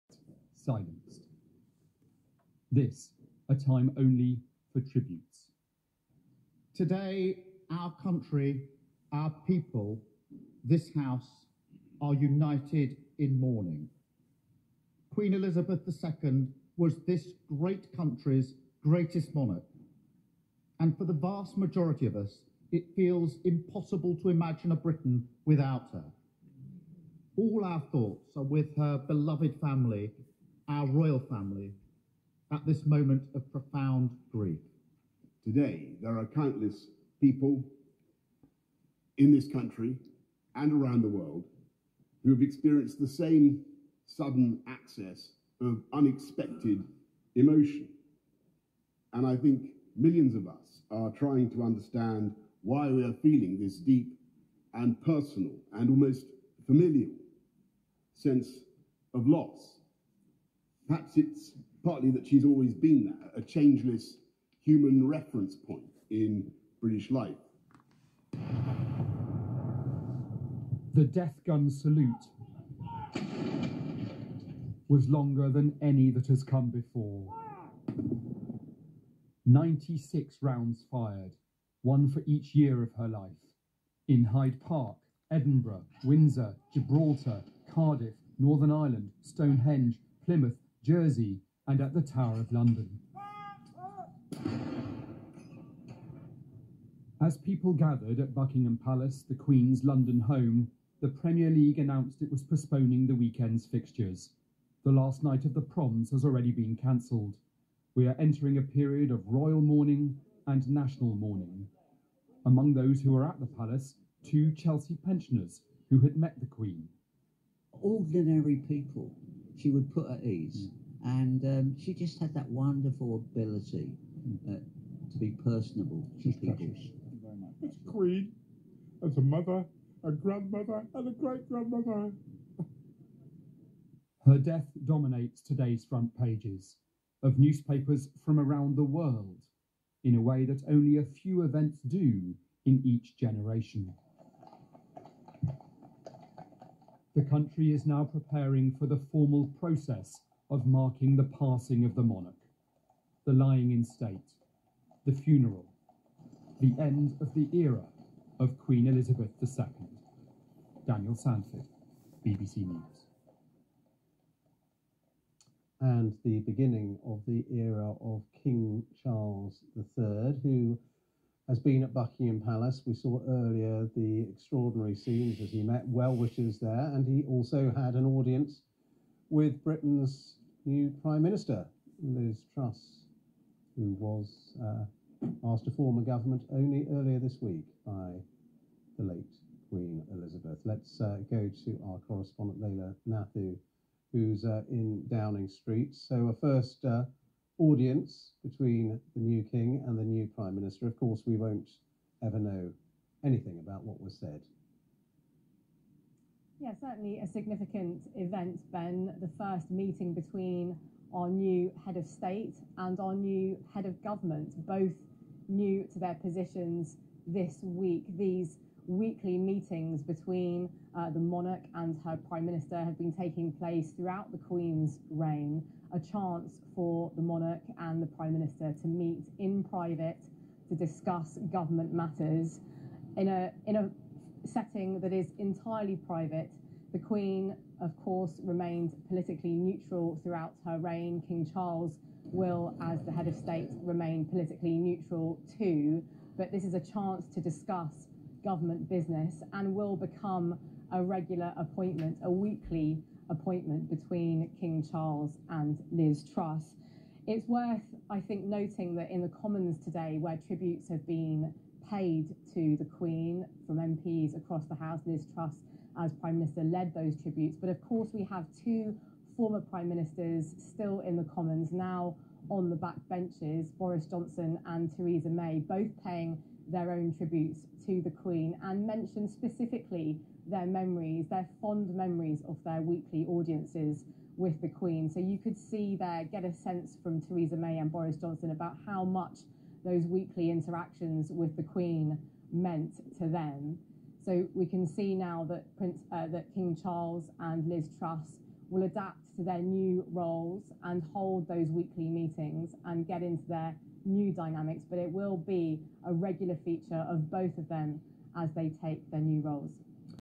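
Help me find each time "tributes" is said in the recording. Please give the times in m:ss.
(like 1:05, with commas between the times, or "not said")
0:04, 4:20, 4:27, 4:37.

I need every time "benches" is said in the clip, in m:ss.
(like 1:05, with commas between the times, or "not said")
4:33.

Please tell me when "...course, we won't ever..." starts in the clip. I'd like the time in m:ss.
3:20.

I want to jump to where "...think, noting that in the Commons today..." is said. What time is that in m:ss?
4:18.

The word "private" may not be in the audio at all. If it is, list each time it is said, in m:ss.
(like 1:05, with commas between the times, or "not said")
3:49, 3:56.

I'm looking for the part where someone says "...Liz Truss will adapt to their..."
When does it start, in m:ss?
4:57.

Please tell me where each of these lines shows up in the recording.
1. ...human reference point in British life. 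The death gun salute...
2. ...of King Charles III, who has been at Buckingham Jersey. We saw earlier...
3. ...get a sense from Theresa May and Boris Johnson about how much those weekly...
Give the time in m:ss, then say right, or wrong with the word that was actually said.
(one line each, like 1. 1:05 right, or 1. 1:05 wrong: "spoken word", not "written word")
1. 1:04 right
2. 2:48 wrong: "Palace", not "Jersey"
3. 4:46 right.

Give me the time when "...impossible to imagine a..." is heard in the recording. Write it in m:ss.
0:23.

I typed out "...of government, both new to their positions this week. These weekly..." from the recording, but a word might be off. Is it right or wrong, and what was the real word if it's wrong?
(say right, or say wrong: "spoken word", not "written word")
right.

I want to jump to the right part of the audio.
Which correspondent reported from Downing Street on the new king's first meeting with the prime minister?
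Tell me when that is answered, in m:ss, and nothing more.
3:12.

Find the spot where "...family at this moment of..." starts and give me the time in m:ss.
0:31.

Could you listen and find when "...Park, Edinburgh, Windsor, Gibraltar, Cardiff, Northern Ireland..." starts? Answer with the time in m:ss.
1:24.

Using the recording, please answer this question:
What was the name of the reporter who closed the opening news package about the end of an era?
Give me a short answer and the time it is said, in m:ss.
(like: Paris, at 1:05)
Daniel Sandford, at 2:40.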